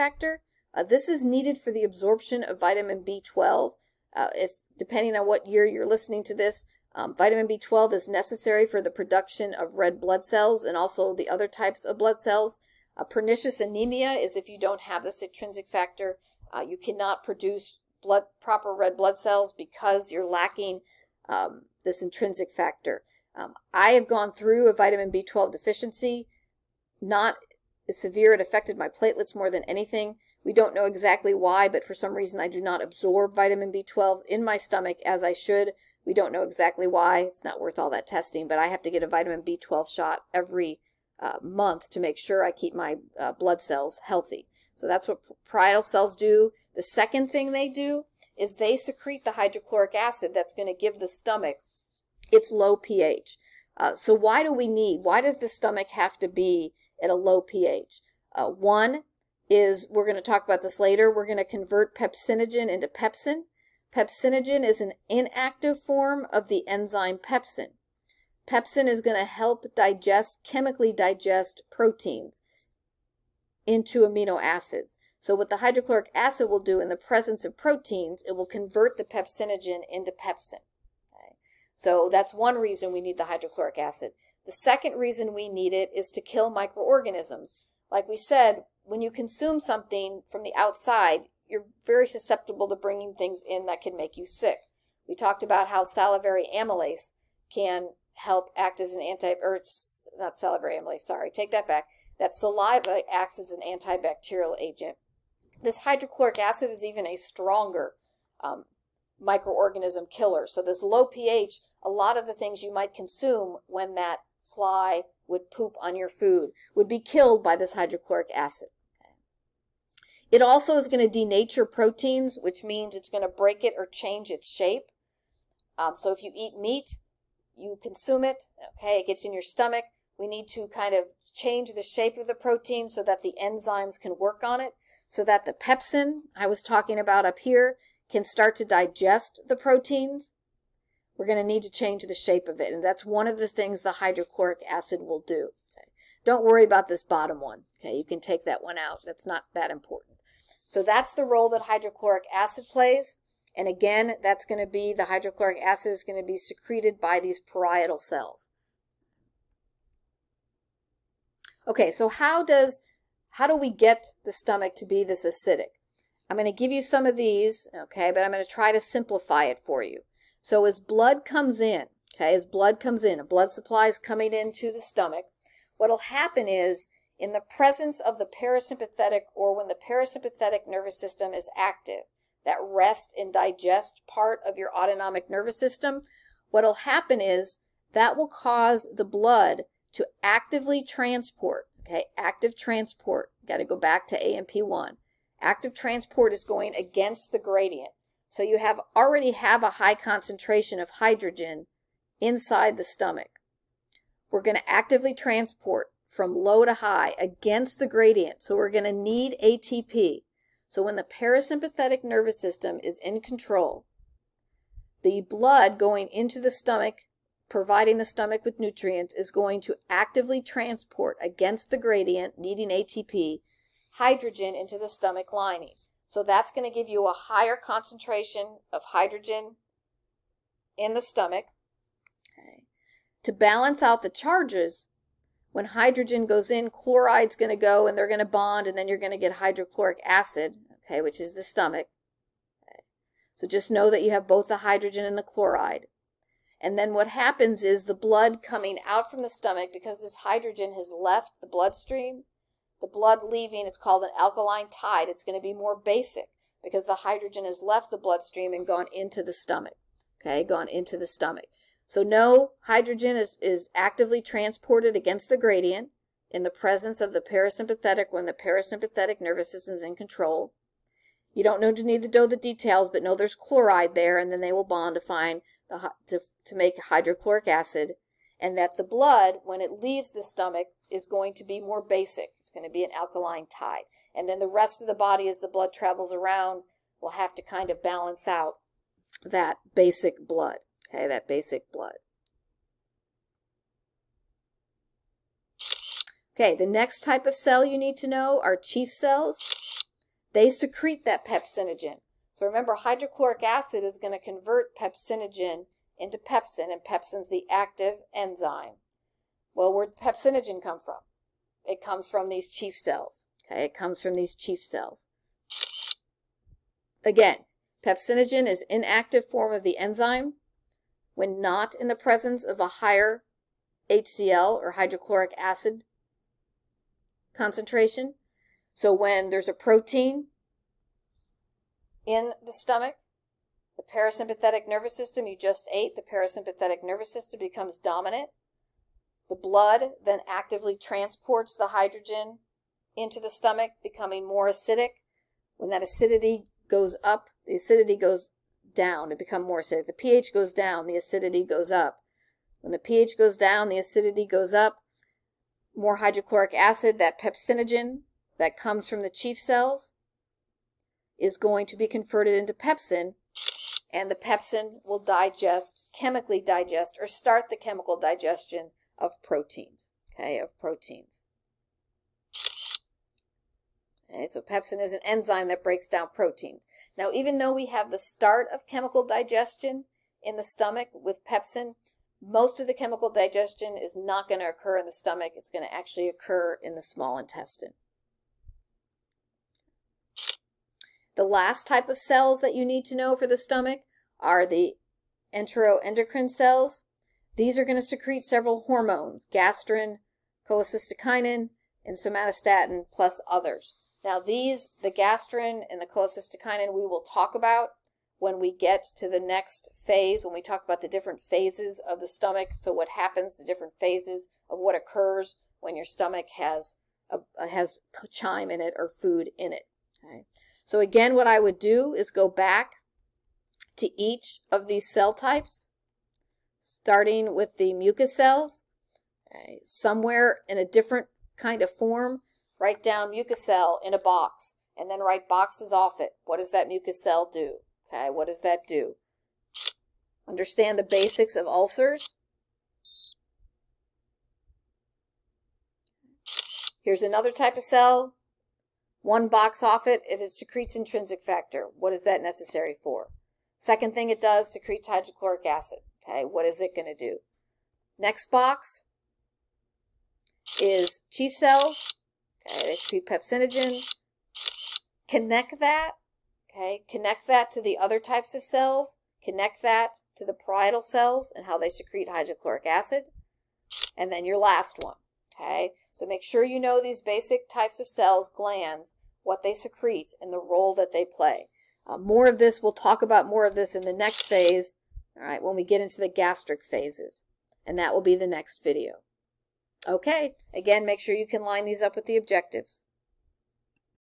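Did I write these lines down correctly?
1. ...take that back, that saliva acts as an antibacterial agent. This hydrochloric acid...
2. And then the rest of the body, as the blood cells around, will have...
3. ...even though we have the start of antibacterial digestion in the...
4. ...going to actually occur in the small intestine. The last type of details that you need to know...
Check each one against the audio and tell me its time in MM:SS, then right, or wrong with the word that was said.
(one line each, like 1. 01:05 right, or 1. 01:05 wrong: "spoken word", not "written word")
1. 01:41 right
2. 04:44 wrong: "travels", not "cells"
3. 06:17 wrong: "chemical", not "antibacterial"
4. 06:25 wrong: "cells", not "details".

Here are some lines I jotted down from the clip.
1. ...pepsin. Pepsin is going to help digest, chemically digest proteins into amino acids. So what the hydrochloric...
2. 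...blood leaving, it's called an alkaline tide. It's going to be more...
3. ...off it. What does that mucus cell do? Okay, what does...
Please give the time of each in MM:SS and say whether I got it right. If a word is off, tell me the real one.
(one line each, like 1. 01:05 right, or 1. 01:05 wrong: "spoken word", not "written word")
1. 01:07 right
2. 04:12 right
3. 07:15 right.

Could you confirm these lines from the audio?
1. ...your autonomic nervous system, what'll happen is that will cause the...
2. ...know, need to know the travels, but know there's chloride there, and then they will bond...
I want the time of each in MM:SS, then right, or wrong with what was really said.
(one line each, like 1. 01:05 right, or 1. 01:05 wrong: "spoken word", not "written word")
1. 03:04 right
2. 04:31 wrong: "details", not "travels".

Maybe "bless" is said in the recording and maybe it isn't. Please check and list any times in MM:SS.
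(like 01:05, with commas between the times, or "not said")
not said.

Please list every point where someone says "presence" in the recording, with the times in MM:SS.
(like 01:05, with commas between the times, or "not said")
01:16, 02:57, 04:26, 05:21.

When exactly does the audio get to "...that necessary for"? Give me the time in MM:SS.
07:32.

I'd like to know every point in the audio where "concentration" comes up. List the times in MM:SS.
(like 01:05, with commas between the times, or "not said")
03:19, 03:47, 05:27.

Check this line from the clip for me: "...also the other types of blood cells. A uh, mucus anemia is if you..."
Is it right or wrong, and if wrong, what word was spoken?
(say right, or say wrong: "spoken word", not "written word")
wrong: "pernicious", not "mucus".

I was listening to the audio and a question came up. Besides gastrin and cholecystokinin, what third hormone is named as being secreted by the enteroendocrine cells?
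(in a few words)
somatostatin.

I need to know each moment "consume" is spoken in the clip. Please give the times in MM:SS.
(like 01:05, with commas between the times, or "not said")
01:29, 01:52, 02:07.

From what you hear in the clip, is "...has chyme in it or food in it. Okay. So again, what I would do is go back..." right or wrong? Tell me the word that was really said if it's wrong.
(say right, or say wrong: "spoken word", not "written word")
right.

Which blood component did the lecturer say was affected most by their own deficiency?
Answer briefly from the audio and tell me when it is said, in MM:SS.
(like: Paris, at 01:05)
platelets, at 00:28.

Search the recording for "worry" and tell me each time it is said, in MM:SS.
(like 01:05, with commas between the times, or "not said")
02:26.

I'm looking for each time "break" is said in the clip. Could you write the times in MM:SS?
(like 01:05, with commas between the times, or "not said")
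02:03, 06:15.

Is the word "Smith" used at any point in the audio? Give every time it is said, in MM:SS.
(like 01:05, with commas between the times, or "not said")
not said.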